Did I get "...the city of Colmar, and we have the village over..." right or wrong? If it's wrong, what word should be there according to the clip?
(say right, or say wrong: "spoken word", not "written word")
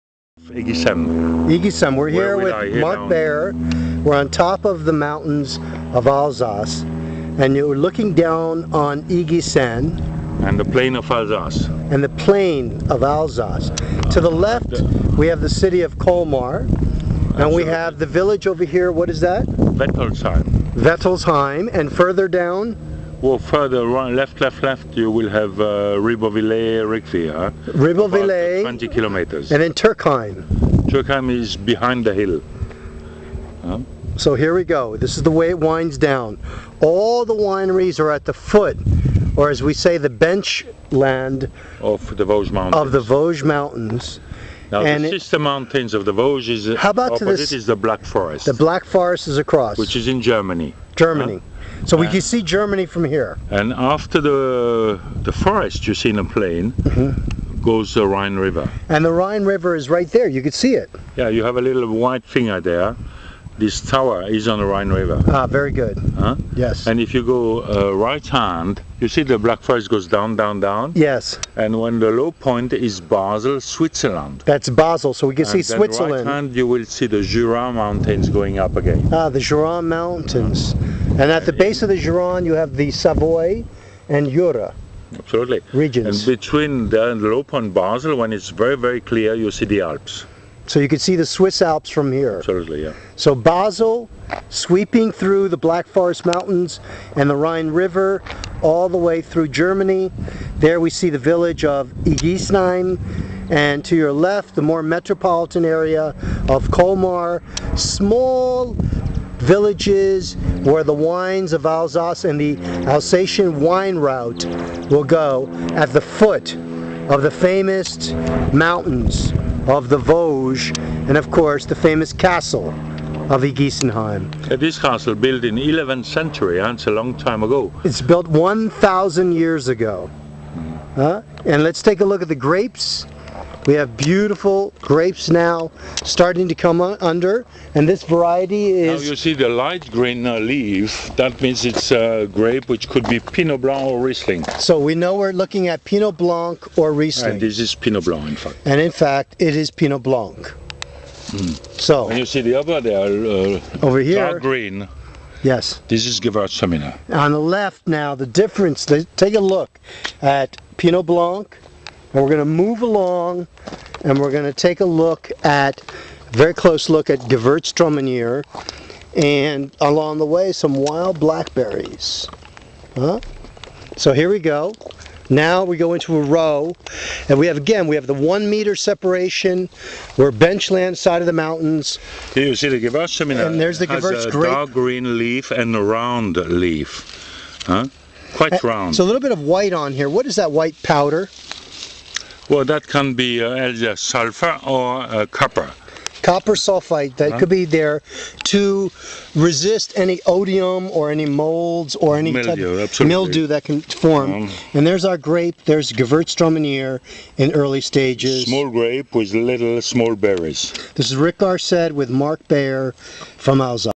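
right.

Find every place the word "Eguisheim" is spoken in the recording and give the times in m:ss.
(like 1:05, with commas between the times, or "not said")
0:00, 0:09, 1:42.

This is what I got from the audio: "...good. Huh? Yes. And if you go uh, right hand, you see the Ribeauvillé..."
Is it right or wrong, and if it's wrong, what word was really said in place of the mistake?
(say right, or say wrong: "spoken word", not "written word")
wrong: "Black", not "Ribeauvillé".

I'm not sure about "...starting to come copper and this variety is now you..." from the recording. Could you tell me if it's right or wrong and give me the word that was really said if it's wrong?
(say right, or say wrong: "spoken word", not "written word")
wrong: "under", not "copper".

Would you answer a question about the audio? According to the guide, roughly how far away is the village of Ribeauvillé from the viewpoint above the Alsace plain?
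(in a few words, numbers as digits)
20 kilometers.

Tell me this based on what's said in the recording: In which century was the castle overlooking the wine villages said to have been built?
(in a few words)
11th century.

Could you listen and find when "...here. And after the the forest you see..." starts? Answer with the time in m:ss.
0:53.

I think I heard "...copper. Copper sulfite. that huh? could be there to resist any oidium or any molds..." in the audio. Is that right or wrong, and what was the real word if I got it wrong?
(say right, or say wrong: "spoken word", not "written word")
right.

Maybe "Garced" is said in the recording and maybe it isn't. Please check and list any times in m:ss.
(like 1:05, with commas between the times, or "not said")
3:31.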